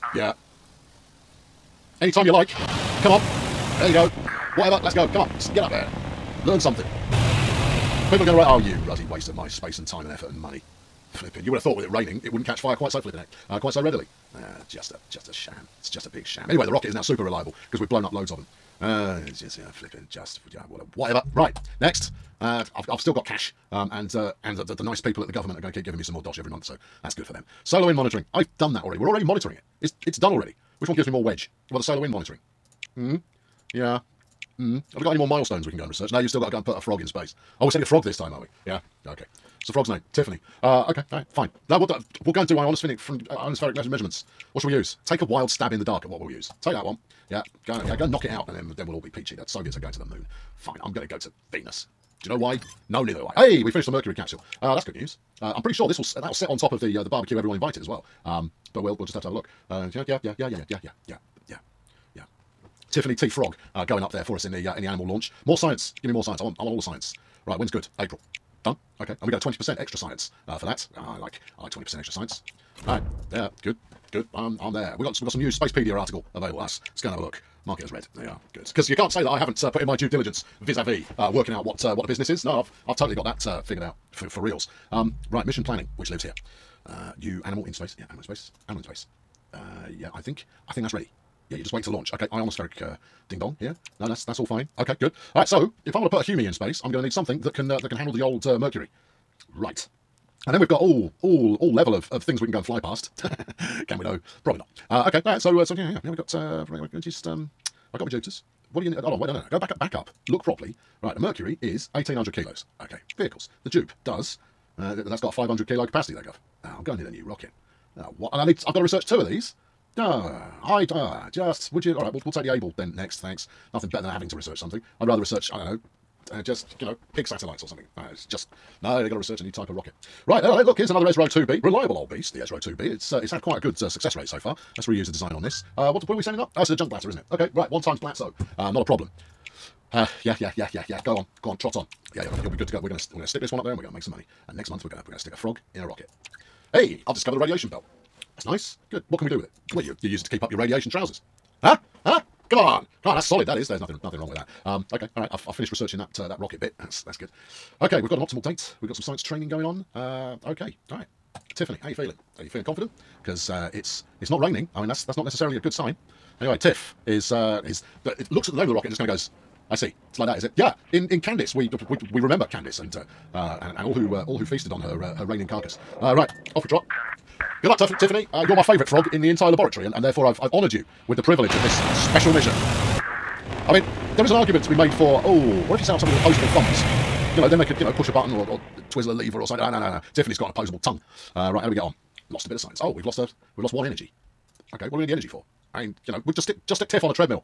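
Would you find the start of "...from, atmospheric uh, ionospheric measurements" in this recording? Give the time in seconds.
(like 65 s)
42 s.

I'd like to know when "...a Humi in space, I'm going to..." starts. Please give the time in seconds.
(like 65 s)
96 s.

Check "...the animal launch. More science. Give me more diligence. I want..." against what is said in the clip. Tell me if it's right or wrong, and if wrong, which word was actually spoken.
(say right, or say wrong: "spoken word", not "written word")
wrong: "science", not "diligence".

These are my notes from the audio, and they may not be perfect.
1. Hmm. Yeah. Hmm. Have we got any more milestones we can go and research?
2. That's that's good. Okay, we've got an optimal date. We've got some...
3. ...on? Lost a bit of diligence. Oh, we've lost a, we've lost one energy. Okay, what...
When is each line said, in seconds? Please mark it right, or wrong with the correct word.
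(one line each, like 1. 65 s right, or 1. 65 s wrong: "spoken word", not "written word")
1. 32 s right
2. 156 s right
3. 191 s wrong: "science", not "diligence".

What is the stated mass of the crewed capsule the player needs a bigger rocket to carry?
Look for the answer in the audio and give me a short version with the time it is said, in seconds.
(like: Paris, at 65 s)
1800 kilos, at 111 s.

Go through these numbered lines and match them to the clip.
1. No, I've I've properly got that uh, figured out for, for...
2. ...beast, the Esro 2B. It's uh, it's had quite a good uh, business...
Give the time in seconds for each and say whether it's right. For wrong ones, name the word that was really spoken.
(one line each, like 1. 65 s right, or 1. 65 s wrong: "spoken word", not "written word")
1. 82 s wrong: "totally", not "properly"
2. 132 s wrong: "success", not "business".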